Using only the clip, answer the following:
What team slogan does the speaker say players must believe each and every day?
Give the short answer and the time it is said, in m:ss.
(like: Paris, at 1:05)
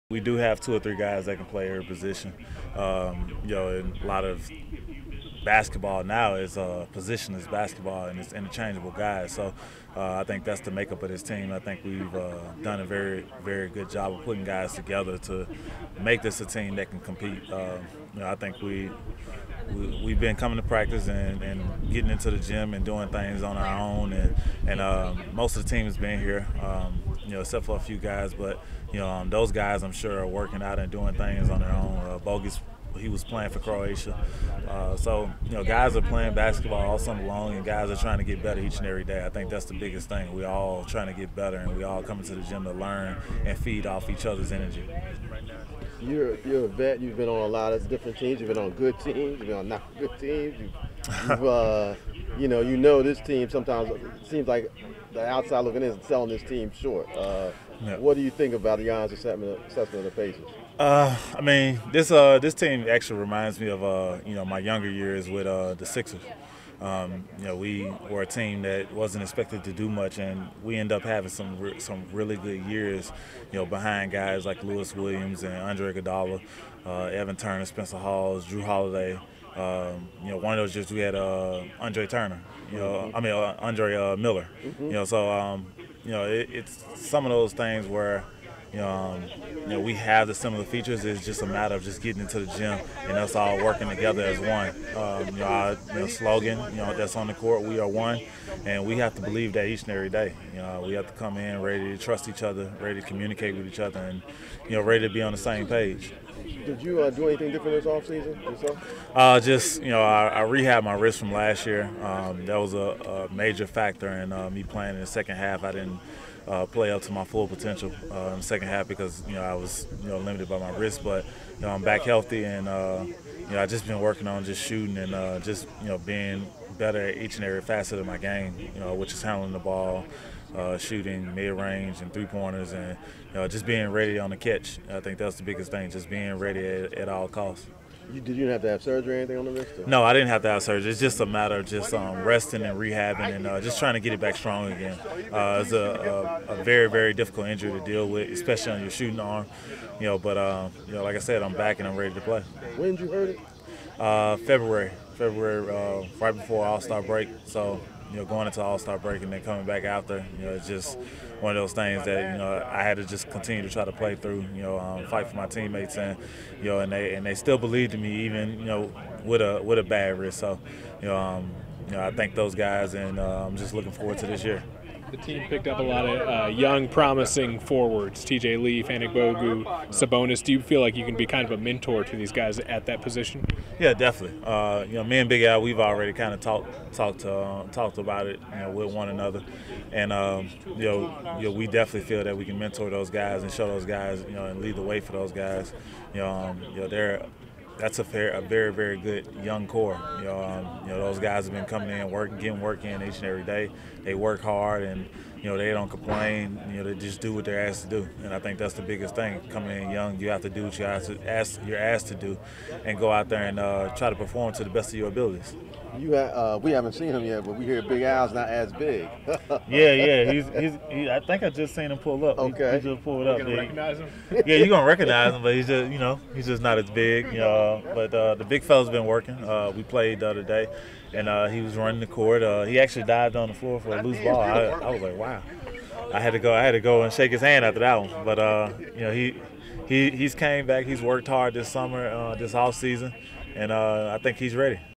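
We are one, at 1:37.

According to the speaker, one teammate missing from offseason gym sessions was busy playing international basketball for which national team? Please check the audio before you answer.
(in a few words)
Croatia.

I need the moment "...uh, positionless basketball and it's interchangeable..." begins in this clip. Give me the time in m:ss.
0:06.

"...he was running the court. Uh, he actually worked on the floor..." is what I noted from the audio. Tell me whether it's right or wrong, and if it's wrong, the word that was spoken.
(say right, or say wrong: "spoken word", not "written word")
wrong: "dived", not "worked".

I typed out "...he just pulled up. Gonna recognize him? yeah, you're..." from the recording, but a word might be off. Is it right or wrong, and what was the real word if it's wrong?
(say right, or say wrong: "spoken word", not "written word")
right.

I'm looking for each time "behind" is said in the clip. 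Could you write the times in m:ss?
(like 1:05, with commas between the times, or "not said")
1:13.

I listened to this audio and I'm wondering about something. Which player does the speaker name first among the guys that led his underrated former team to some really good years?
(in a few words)
Lou Williams.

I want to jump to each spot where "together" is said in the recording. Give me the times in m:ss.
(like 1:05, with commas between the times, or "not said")
0:14, 1:33.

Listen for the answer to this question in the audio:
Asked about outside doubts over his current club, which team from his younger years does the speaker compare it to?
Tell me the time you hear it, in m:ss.
1:05.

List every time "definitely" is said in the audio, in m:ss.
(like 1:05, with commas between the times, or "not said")
3:03, 3:11.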